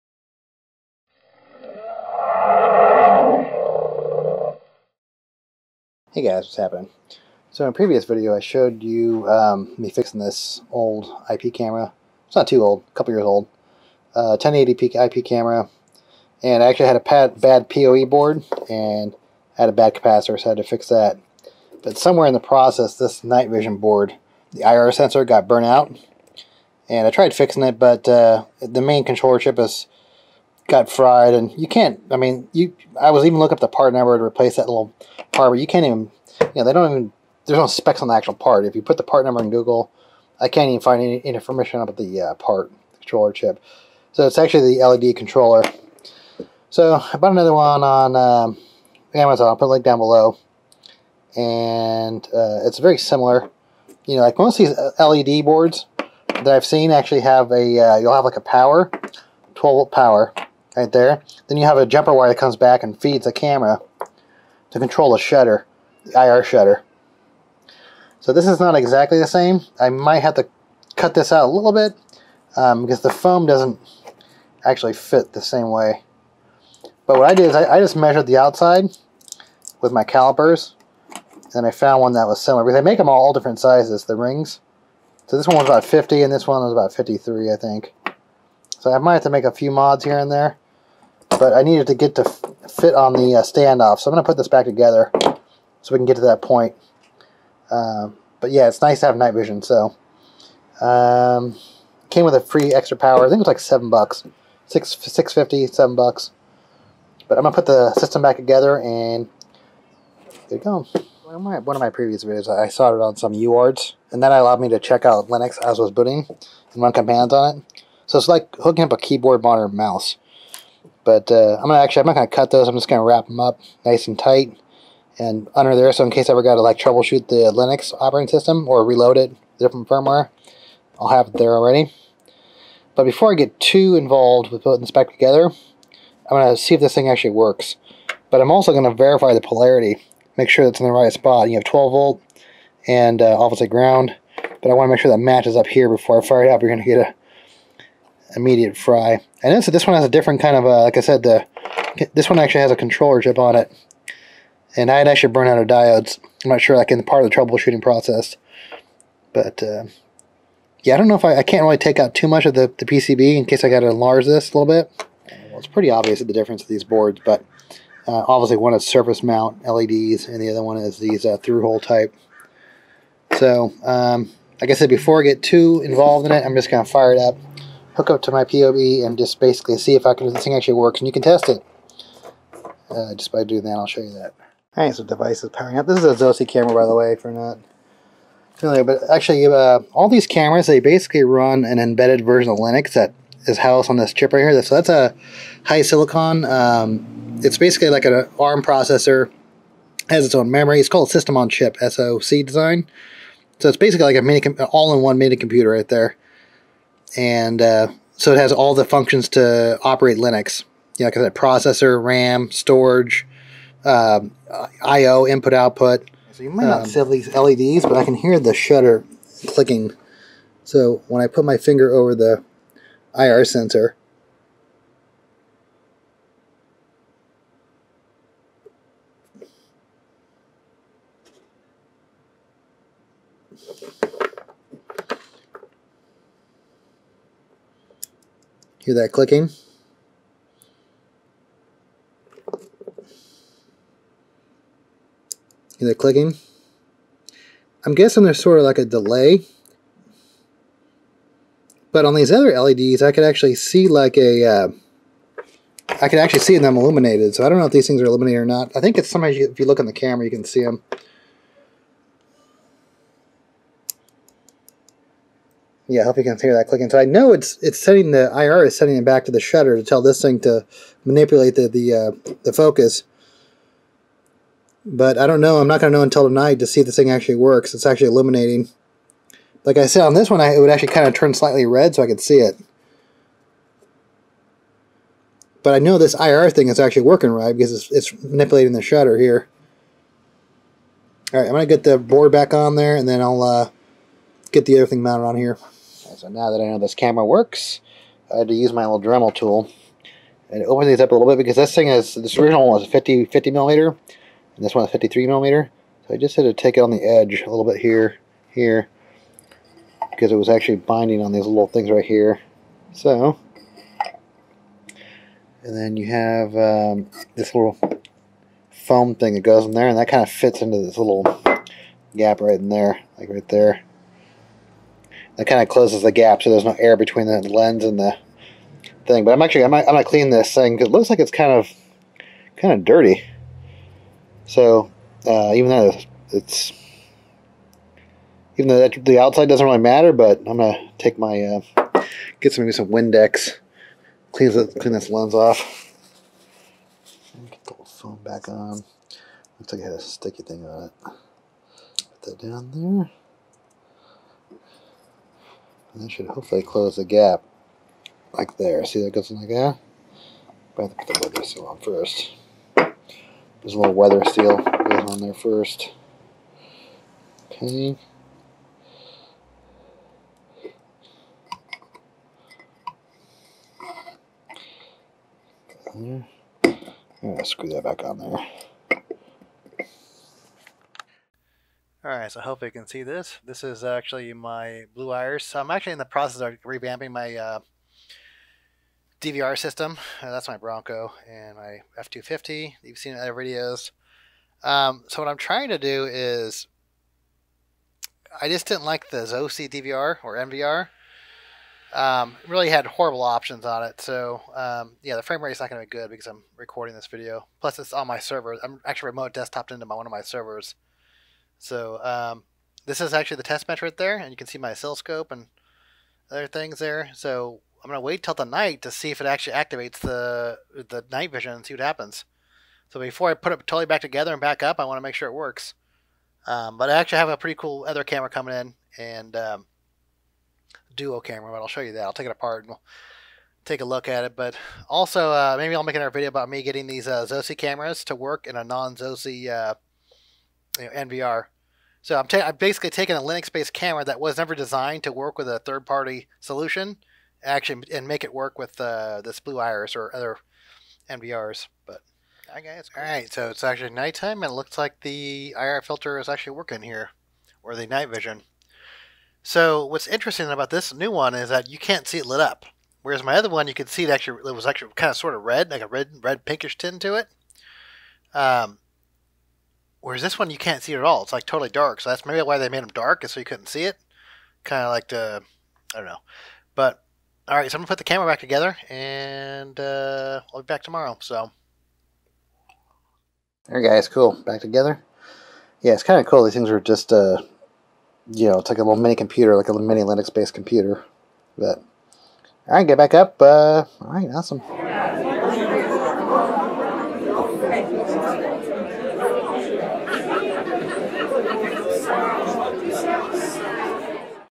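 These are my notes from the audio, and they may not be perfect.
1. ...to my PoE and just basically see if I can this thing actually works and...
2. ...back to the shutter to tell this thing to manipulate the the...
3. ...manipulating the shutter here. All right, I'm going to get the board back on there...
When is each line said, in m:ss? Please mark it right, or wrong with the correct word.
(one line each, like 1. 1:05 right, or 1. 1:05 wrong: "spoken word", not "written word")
1. 2:58 right
2. 4:29 right
3. 4:48 right.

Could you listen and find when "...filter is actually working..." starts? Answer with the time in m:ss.
7:35.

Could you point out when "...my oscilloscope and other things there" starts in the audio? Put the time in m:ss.
6:54.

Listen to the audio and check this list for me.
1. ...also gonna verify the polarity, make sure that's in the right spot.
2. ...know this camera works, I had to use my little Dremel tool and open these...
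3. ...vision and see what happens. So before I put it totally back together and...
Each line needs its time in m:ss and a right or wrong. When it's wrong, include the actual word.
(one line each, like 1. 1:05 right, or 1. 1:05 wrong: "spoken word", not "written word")
1. 2:18 right
2. 4:56 right
3. 7:01 right.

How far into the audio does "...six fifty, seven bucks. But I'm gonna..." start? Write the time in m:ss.
1:44.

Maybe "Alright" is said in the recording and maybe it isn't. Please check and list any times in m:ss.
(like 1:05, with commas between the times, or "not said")
3:04, 6:22.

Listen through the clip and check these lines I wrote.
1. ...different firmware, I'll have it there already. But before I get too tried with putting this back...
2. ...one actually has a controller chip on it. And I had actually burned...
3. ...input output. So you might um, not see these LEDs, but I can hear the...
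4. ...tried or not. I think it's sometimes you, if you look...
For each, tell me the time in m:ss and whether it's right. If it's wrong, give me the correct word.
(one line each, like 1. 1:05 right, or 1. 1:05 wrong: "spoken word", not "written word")
1. 2:09 wrong: "involved", not "tried"
2. 2:32 right
3. 3:35 right
4. 4:18 wrong: "illuminated", not "tried".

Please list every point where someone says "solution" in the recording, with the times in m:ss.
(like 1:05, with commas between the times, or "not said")
7:26.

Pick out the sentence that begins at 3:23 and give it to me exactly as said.
So it's basically like a mini, all-in-one mini computer right there and uh, so it has all the functions to operate Linux.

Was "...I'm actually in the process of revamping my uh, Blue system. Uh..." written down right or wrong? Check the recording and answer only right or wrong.
wrong.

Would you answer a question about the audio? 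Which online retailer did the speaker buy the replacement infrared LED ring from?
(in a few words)
Amazon.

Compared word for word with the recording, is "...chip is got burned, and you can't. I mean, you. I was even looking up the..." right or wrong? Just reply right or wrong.
wrong.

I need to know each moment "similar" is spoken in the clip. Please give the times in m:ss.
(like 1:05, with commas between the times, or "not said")
0:52, 1:22.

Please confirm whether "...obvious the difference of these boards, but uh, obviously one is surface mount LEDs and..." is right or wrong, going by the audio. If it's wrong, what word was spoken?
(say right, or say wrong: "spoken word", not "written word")
right.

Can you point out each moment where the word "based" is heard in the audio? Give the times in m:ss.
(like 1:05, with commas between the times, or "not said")
7:23, 8:10.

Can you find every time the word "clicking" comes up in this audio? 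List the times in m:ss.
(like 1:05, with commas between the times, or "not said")
3:39, 3:59, 4:05, 4:26.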